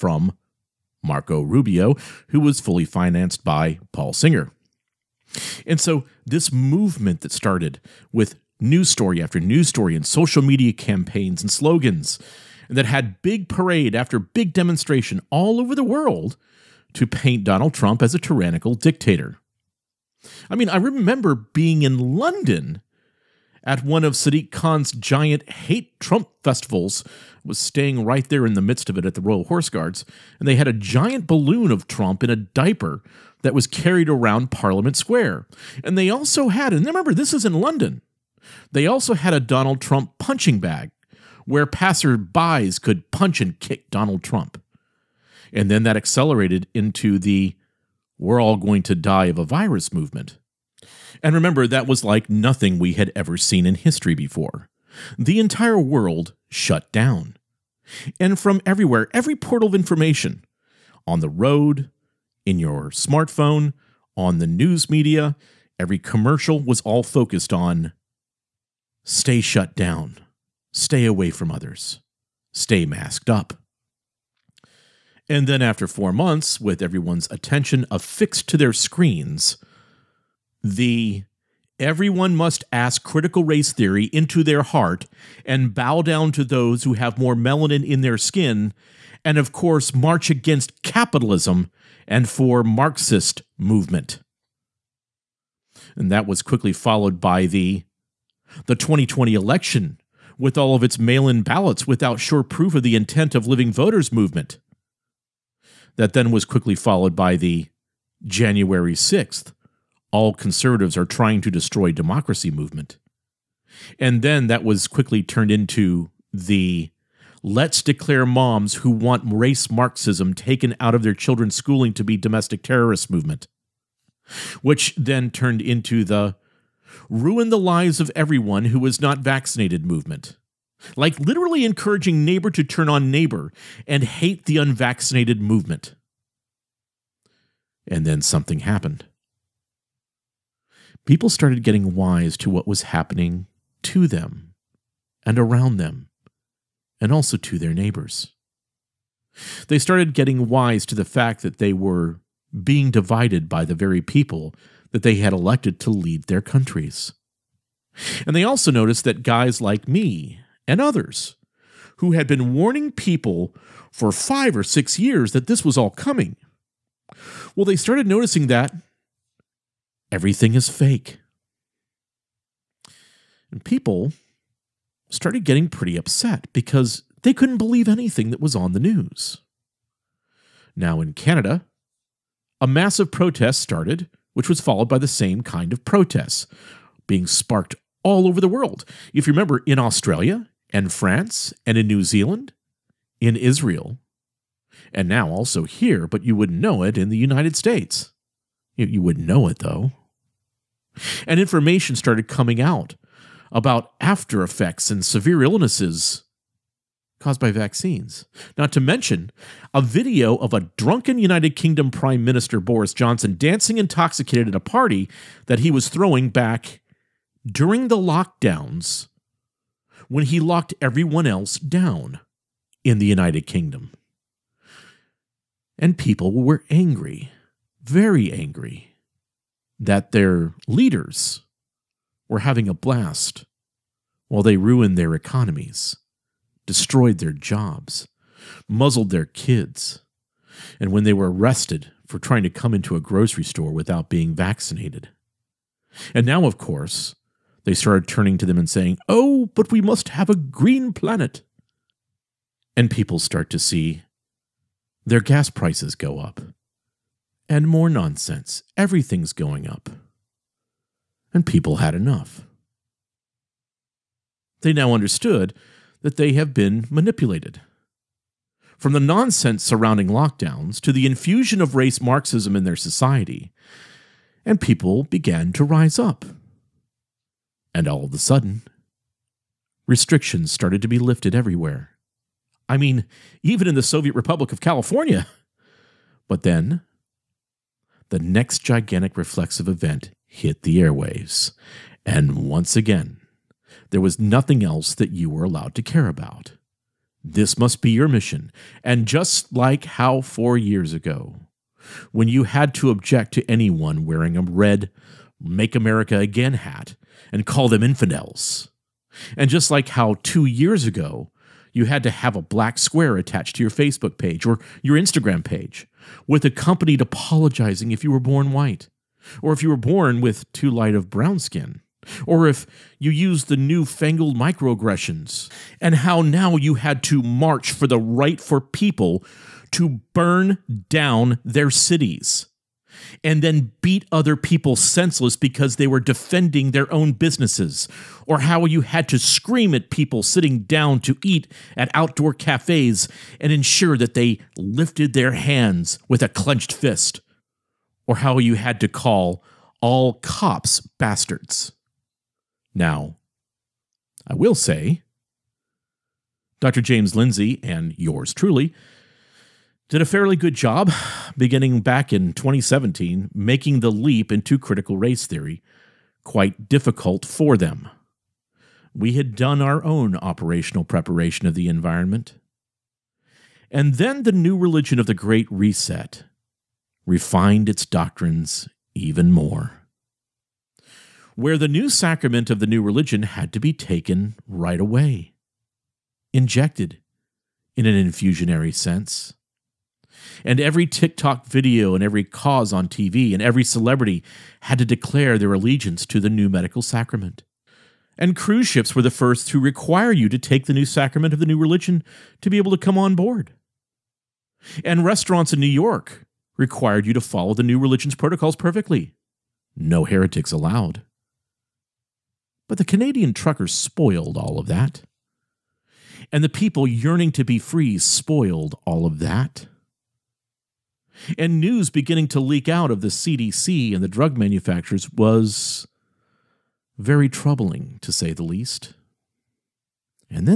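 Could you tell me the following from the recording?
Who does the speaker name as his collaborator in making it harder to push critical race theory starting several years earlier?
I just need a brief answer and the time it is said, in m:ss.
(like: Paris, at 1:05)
James Lindsay, at 5:56.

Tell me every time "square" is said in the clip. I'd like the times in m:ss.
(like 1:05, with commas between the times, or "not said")
0:34, 5:12.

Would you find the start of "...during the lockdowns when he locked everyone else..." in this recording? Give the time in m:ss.
3:37.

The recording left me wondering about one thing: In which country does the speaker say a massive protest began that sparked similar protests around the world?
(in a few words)
Canada.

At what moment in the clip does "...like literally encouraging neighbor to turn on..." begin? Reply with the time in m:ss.
2:10.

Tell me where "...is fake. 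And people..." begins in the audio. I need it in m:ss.
2:50.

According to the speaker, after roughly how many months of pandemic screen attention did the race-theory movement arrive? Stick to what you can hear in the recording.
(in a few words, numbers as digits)
4 months.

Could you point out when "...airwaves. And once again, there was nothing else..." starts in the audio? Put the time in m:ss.
4:50.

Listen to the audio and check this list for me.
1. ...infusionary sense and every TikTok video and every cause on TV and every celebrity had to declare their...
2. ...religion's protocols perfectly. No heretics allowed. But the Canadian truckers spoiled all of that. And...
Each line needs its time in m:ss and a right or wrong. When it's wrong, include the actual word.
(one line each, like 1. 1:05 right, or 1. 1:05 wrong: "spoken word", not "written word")
1. 6:28 right
2. 6:47 right.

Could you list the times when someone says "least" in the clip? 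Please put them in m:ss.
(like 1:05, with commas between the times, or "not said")
7:08.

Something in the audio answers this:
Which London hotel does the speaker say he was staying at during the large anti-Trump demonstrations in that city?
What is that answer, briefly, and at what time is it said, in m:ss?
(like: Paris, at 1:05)
Royal Horse Guards, at 0:29.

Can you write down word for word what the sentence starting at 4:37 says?
And all of a sudden, restrictions started to be lifted everywhere.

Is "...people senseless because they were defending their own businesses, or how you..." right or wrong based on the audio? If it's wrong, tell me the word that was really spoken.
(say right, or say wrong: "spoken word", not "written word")
right.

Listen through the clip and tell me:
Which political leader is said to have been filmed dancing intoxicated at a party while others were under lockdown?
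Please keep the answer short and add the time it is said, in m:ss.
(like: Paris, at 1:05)
Boris Johnson, at 3:32.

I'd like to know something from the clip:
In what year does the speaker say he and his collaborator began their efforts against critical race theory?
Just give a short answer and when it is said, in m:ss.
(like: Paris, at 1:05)
2017, at 6:02.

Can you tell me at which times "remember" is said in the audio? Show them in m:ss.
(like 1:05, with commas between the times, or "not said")
0:20, 0:36, 0:51, 3:09.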